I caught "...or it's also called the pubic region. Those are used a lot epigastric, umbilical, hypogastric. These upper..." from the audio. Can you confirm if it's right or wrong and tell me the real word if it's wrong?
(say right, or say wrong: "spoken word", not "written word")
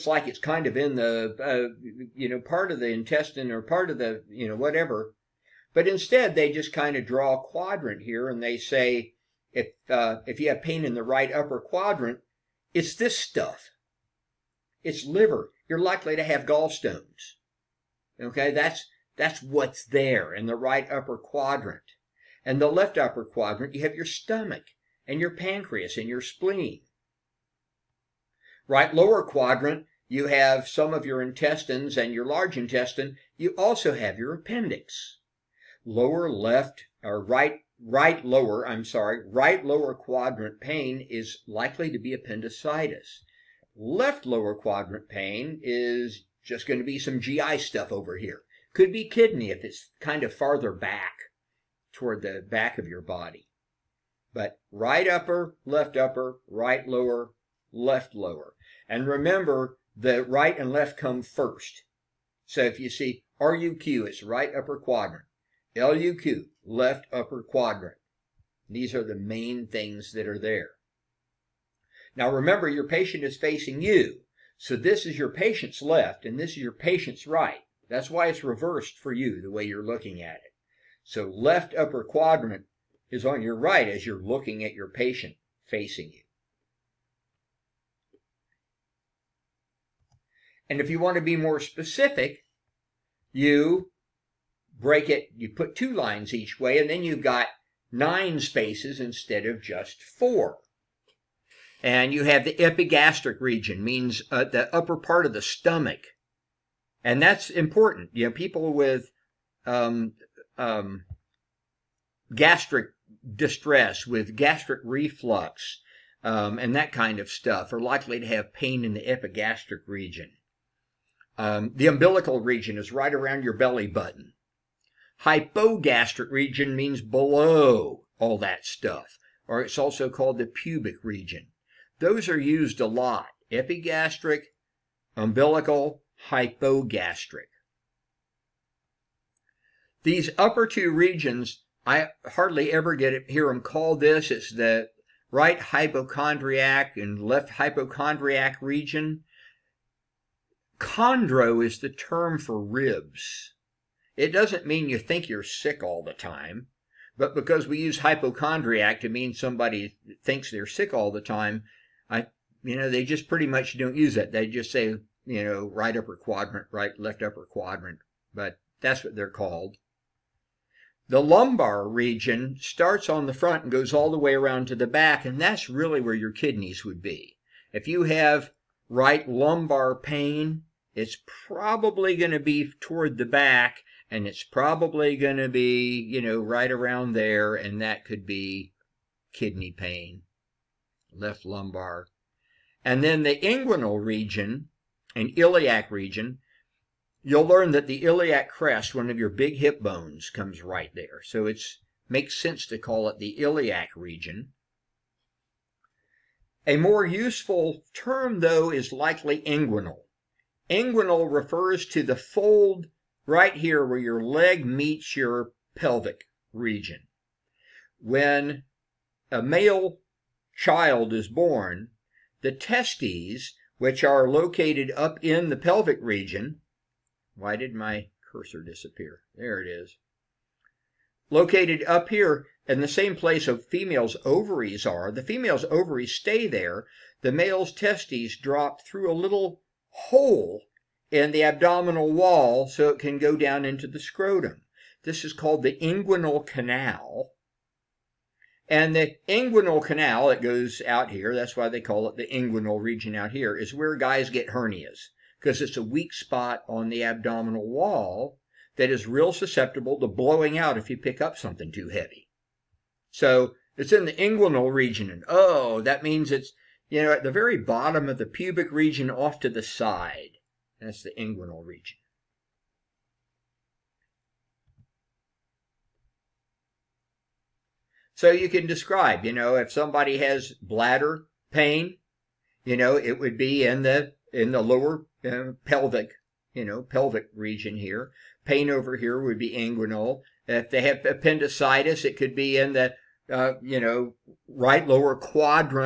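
right.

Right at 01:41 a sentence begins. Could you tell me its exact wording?
And you have the epigastric region, means uh, the upper part of the stomach.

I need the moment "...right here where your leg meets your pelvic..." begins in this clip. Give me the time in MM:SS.
03:33.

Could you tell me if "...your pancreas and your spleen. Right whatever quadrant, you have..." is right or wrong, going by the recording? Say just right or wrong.
wrong.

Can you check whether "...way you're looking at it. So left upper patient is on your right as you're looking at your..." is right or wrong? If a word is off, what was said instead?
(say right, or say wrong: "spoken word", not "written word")
wrong: "quadrant", not "patient".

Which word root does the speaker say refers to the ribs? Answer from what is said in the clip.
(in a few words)
Chondro.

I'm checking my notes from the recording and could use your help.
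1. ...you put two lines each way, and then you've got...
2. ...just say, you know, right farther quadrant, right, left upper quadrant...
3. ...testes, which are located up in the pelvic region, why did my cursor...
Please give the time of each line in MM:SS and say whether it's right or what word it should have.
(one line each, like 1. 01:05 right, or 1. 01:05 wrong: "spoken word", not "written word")
1. 01:35 right
2. 02:44 wrong: "upper", not "farther"
3. 03:42 right.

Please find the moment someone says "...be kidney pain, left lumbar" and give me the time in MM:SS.
03:08.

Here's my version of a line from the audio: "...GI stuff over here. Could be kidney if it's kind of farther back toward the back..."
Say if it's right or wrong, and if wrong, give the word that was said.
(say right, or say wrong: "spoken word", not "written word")
right.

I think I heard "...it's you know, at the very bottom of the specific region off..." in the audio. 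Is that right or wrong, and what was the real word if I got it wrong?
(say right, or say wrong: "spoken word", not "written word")
wrong: "pubic", not "specific".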